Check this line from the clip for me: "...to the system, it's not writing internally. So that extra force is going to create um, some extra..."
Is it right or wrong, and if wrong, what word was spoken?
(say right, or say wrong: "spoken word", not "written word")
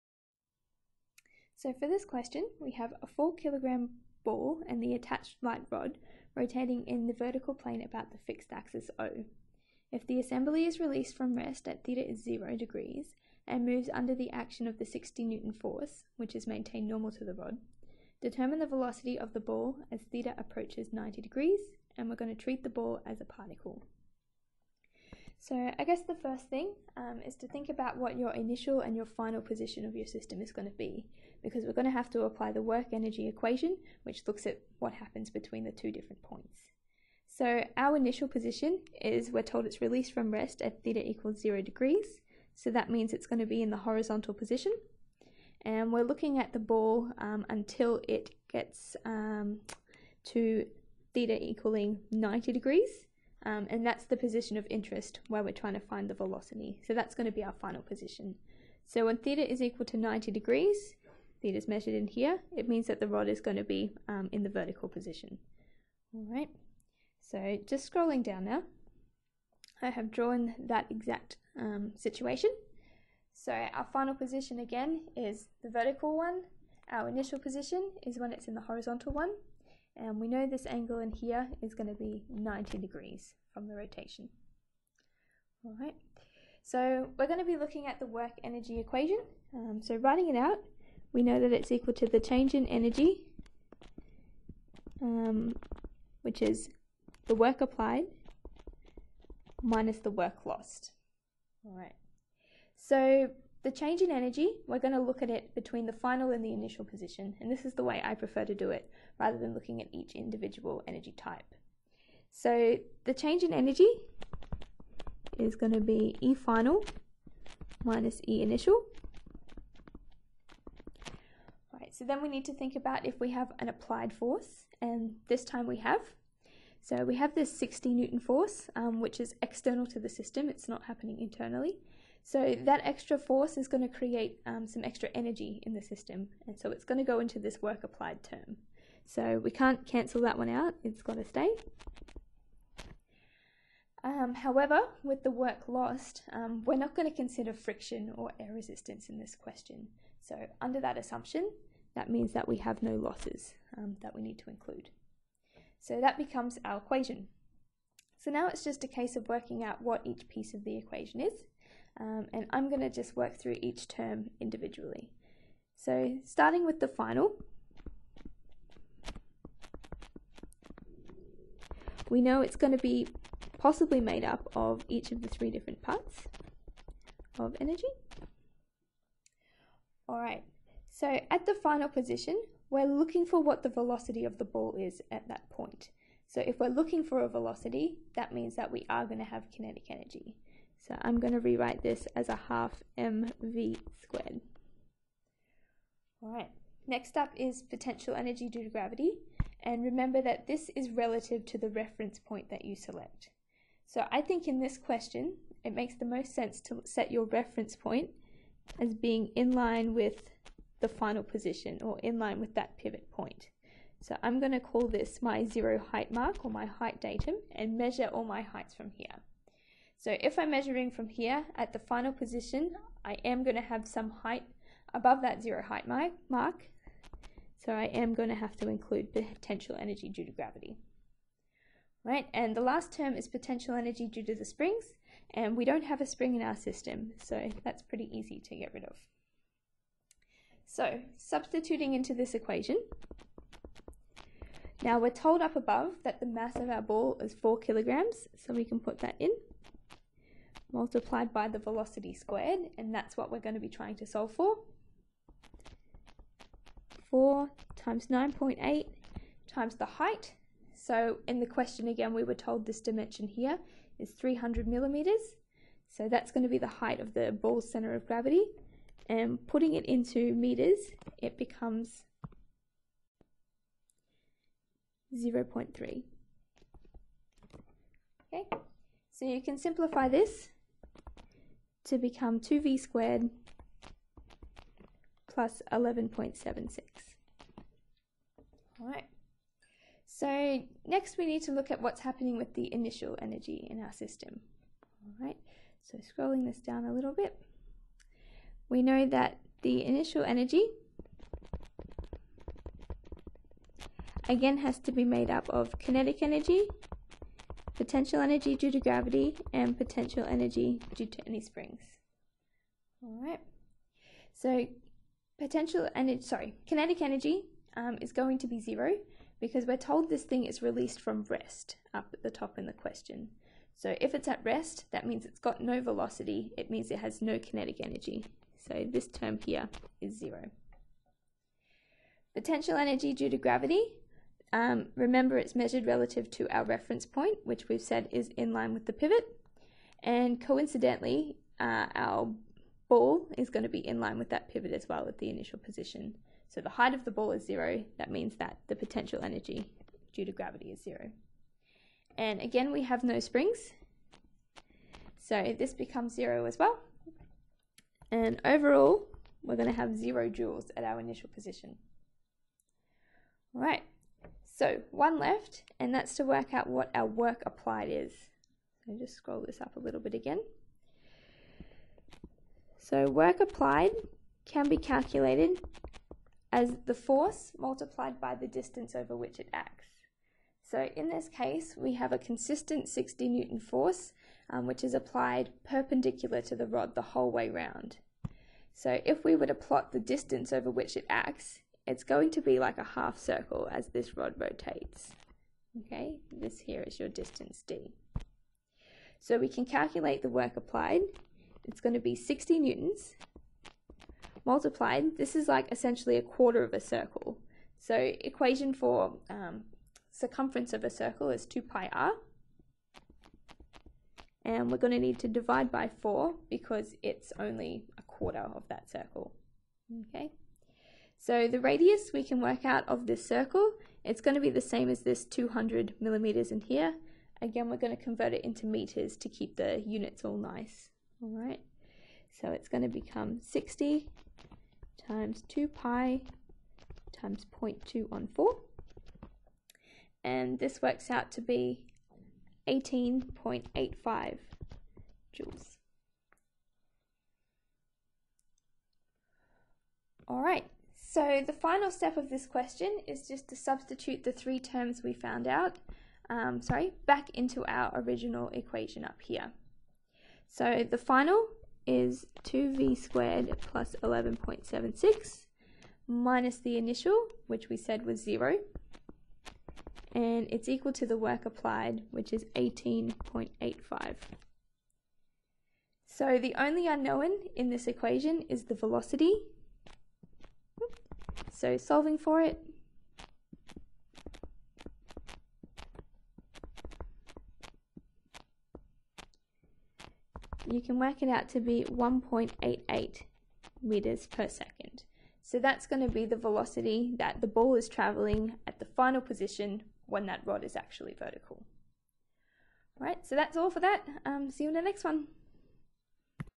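wrong: "happening", not "writing".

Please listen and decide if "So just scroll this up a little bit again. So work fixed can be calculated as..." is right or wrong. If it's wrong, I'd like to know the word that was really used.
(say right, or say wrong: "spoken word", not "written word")
wrong: "applied", not "fixed".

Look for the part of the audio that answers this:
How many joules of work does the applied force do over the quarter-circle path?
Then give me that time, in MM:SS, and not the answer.
07:22.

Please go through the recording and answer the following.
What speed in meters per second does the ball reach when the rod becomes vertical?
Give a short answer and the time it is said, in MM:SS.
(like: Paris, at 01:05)
1.88 m/s, at 08:11.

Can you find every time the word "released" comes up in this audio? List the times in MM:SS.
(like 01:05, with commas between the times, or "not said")
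00:10, 00:39, 05:20.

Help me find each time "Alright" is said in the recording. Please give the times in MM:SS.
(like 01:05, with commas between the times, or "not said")
03:00.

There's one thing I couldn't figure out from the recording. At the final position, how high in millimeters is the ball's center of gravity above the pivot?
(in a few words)
300 mm.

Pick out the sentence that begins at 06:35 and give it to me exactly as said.
Okay, this here is your distance D.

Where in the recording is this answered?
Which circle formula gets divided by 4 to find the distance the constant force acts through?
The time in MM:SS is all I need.
06:51.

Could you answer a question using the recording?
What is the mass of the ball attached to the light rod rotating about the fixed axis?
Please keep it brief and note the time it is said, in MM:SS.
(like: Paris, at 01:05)
4 kg, at 00:03.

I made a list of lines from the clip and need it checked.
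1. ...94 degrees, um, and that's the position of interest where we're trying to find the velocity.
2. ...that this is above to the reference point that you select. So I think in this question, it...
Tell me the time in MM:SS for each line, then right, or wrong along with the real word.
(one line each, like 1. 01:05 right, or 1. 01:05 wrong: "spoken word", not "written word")
1. 00:52 wrong: "90", not "94"
2. 03:20 wrong: "relative", not "above".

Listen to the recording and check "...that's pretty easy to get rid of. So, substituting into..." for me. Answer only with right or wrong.
right.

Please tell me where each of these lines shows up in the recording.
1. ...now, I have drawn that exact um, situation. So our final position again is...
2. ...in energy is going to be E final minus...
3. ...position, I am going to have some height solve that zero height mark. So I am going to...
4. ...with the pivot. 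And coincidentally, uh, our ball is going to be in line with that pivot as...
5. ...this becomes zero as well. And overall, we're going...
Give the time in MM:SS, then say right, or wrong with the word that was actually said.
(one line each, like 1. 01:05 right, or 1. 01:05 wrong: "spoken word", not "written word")
1. 01:08 right
2. 01:53 right
3. 03:42 wrong: "above", not "solve"
4. 05:38 right
5. 05:55 right.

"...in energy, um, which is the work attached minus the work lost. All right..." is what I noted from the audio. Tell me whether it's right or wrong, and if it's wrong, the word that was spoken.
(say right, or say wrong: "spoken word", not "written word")
wrong: "applied", not "attached".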